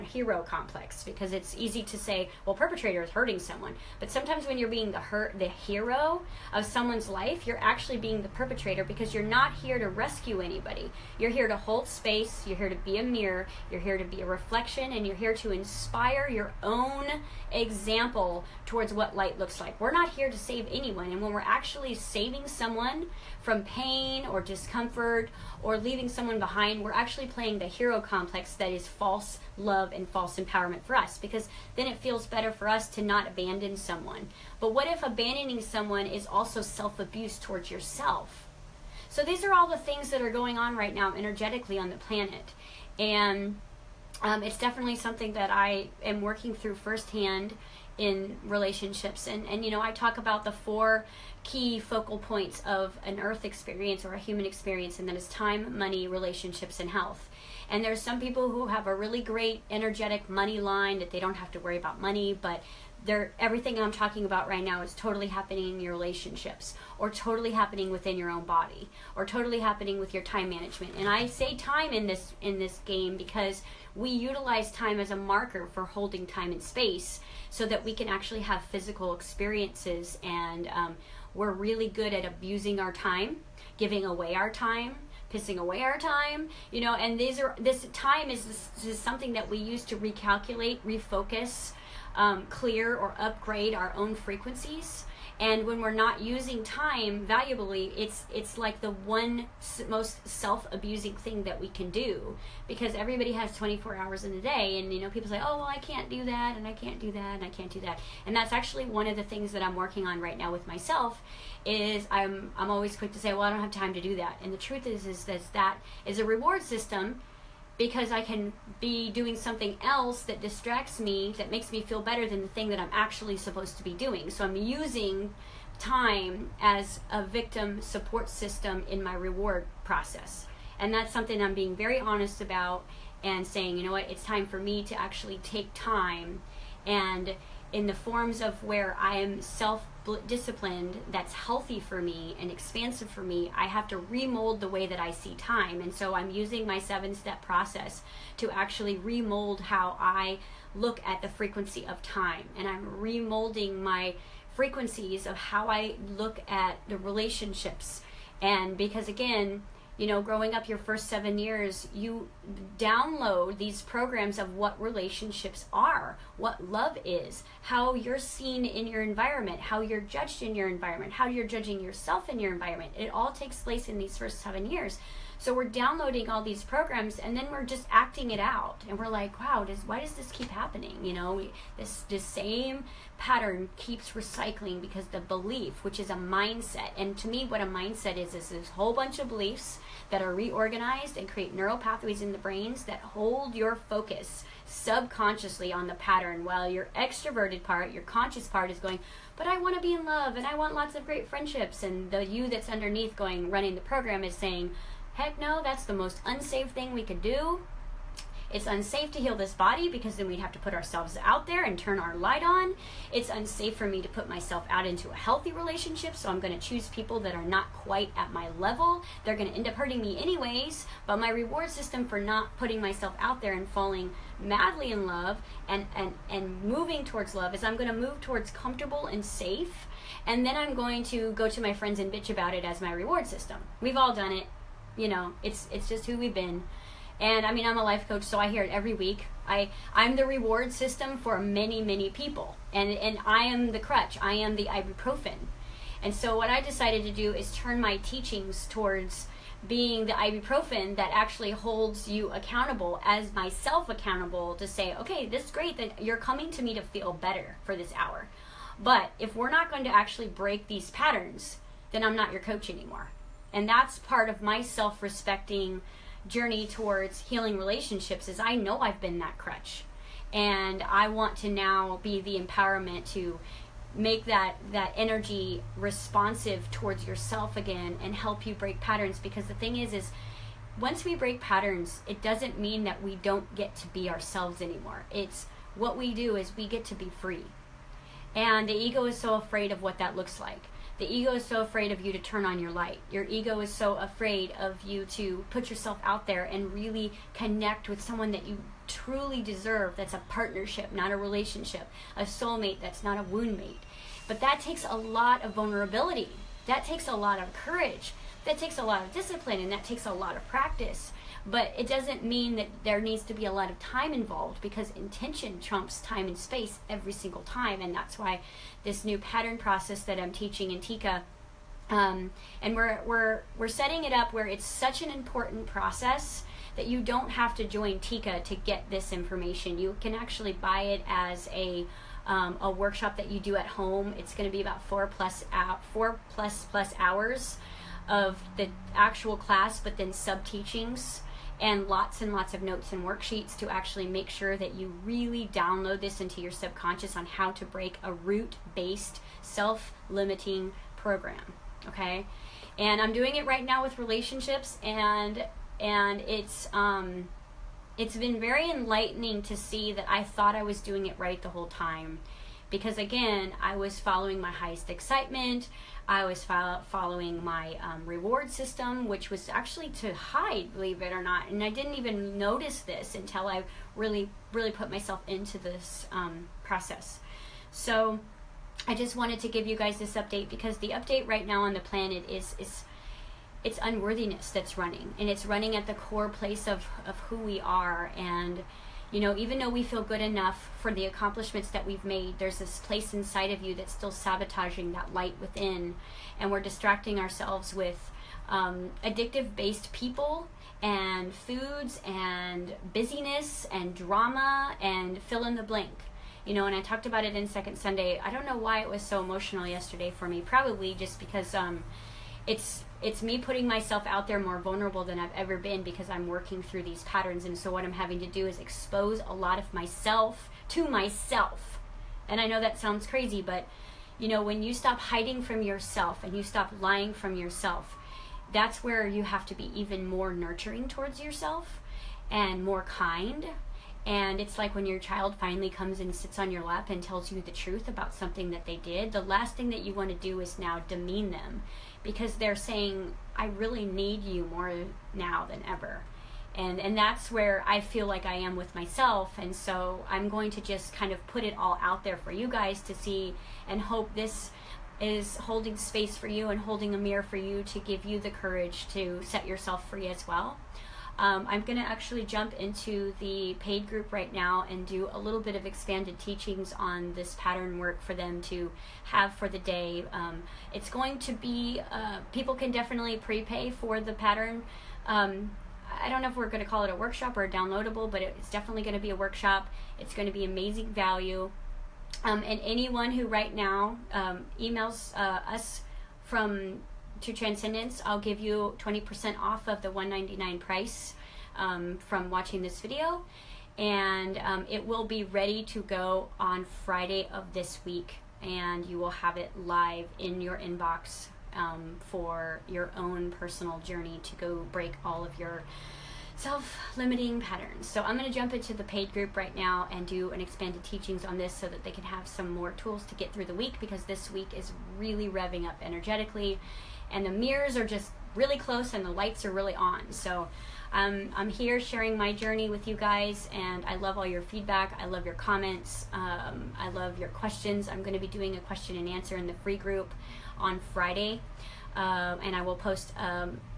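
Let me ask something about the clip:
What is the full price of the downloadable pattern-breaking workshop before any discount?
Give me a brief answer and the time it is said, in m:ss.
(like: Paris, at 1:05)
199, at 8:09.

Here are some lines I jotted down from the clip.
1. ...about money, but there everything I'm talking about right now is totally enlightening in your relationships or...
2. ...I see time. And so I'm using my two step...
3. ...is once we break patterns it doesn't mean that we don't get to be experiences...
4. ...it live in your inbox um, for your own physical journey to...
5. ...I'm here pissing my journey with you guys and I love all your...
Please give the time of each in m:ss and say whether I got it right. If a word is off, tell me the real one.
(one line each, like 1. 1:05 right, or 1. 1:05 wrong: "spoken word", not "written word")
1. 1:01 wrong: "happening", not "enlightening"
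2. 2:24 wrong: "seven", not "two"
3. 4:39 wrong: "ourselves", not "experiences"
4. 8:19 wrong: "personal", not "physical"
5. 8:41 wrong: "sharing", not "pissing".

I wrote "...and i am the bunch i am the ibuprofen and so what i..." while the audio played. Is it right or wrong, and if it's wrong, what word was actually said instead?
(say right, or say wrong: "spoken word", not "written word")
wrong: "crutch", not "bunch".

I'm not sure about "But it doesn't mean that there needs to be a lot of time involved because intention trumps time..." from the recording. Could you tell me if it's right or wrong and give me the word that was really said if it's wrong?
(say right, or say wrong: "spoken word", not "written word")
right.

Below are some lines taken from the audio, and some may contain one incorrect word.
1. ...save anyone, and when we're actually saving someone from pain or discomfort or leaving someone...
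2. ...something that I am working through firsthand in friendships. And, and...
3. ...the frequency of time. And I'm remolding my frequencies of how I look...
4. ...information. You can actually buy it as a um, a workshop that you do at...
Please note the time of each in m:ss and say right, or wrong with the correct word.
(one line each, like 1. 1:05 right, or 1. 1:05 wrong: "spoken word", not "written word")
1. 0:20 right
2. 0:44 wrong: "relationships", not "friendships"
3. 2:31 right
4. 5:29 right.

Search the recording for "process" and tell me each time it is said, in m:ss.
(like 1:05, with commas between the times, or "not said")
2:09, 2:27, 5:19, 5:25, 6:16.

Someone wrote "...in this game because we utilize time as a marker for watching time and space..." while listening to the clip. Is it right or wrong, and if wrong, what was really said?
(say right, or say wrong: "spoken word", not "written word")
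wrong: "holding", not "watching".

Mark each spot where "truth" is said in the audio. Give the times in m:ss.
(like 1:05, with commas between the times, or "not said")
1:54, 7:17.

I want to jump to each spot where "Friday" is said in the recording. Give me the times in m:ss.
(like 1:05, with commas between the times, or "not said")
8:16, 8:50.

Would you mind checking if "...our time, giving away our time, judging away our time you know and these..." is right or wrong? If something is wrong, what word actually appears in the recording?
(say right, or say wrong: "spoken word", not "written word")
wrong: "pissing", not "judging".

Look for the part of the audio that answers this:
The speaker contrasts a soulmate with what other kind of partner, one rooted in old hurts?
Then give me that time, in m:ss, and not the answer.
5:03.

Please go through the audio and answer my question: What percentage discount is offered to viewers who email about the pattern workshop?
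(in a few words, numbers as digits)
20%.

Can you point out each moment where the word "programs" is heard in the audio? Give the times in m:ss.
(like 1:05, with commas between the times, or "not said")
2:43, 2:56, 3:23, 5:50.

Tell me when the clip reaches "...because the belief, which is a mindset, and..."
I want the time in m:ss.
3:04.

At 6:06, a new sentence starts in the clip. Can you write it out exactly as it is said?
I was fo- following my um, reward system, which was actually to hide, believe it or not.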